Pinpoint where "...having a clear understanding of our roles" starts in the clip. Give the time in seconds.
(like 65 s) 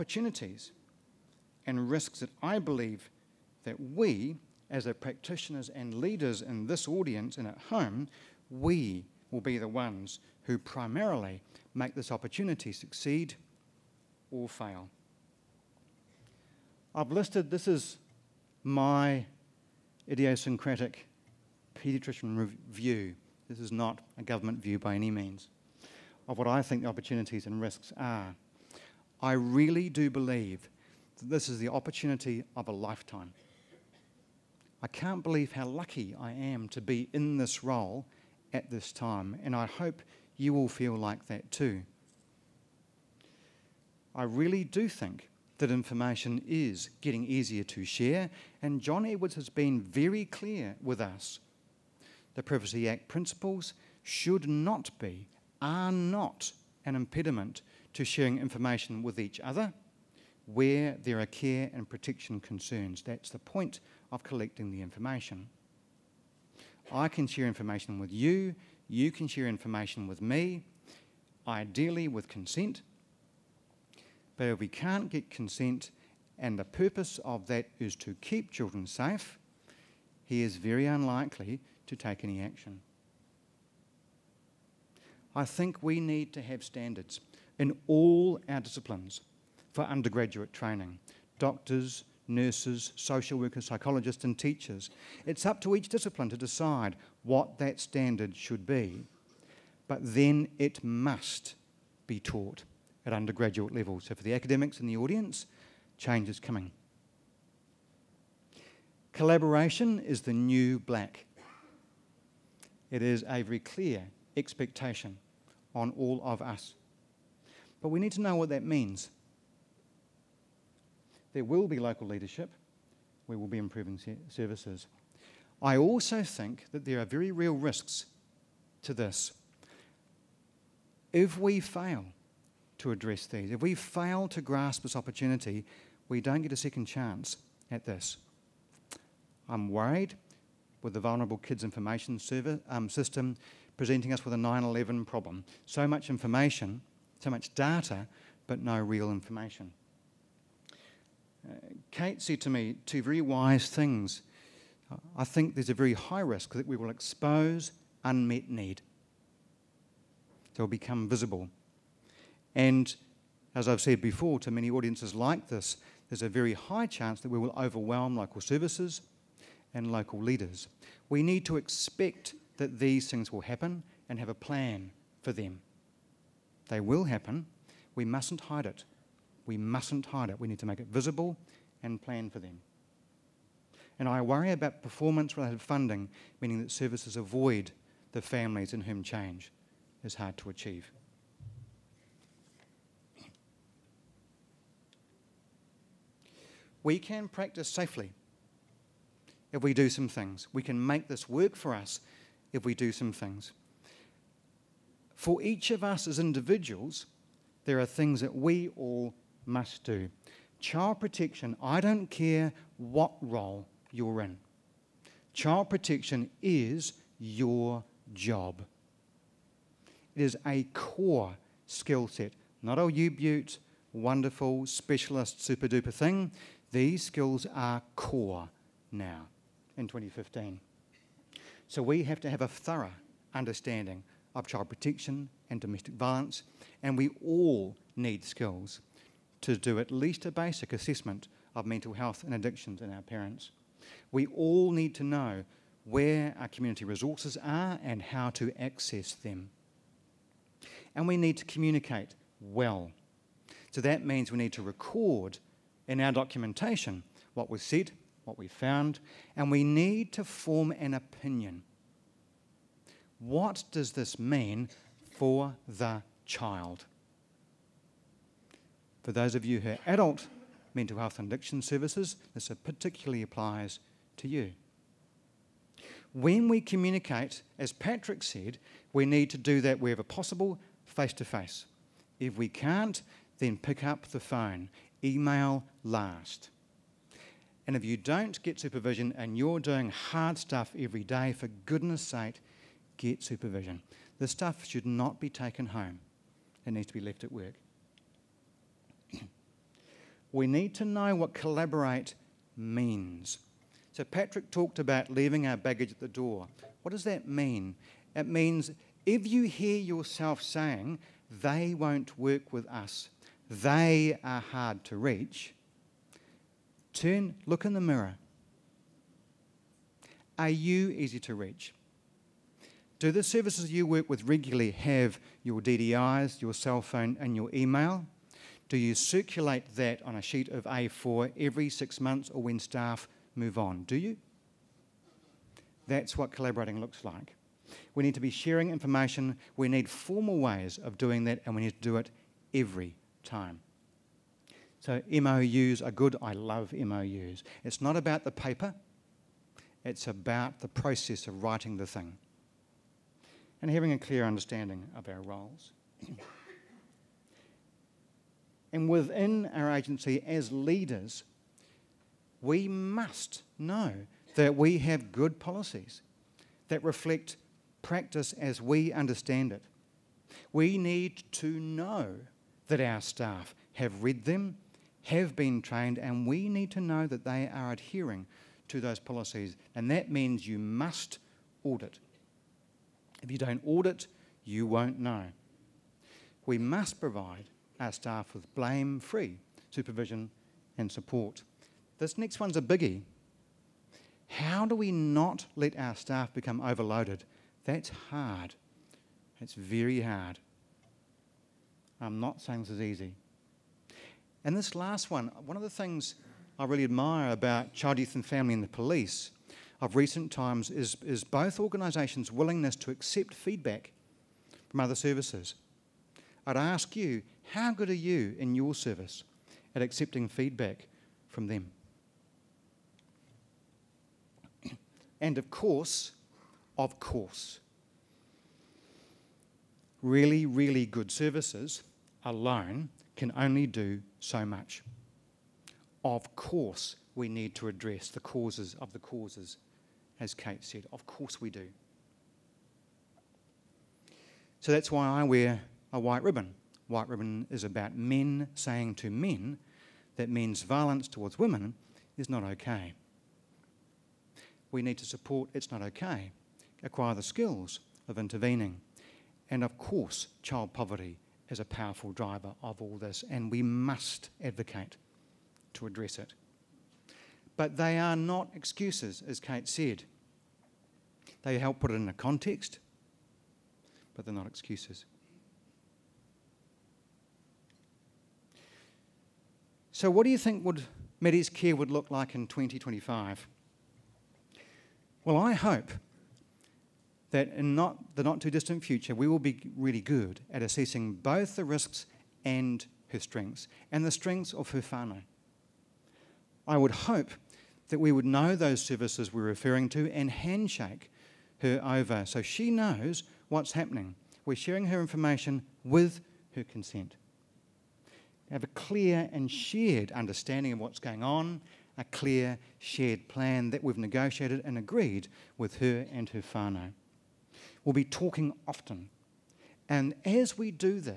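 353 s.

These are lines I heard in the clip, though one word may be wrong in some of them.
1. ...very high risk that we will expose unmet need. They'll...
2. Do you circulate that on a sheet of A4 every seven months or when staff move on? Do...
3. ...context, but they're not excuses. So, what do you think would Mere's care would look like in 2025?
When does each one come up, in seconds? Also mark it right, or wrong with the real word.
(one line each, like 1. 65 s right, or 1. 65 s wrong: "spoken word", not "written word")
1. 155 s right
2. 328 s wrong: "six", not "seven"
3. 472 s right.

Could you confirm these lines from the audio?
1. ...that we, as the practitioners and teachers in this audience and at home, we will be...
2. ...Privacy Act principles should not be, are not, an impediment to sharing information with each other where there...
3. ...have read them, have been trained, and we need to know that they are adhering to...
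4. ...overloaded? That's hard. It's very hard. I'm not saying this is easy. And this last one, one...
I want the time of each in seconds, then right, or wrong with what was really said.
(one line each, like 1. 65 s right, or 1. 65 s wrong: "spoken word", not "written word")
1. 3 s wrong: "leaders", not "teachers"
2. 52 s right
3. 373 s right
4. 396 s right.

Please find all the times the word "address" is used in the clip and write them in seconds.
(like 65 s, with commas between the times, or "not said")
132 s, 437 s, 465 s.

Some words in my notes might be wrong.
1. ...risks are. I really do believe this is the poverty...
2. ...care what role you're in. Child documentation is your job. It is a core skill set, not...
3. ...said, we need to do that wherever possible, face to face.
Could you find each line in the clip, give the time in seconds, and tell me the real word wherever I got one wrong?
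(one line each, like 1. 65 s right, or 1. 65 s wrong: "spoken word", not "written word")
1. 27 s wrong: "opportunity", not "poverty"
2. 212 s wrong: "protection", not "documentation"
3. 278 s right.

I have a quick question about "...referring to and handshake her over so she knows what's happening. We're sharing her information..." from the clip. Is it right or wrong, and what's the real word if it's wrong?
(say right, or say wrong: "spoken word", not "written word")
right.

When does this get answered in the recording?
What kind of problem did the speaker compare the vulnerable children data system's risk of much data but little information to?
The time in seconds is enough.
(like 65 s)
144 s.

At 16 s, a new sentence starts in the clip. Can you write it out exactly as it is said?
I've listed this is my idiosyncratic pediatrician view.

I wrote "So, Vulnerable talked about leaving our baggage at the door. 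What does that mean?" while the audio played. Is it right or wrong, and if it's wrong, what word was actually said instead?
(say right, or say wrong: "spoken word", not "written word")
wrong: "Patrick", not "Vulnerable".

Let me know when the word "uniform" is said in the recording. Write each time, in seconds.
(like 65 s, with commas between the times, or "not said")
not said.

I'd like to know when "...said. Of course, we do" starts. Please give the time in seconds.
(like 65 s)
440 s.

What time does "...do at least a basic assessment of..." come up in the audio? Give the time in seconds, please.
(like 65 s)
239 s.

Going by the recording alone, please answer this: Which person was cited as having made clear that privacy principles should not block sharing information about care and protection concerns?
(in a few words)
John Edwards.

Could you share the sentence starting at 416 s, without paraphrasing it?
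I'd ask you, how good are you in your service at accepting feedback from them?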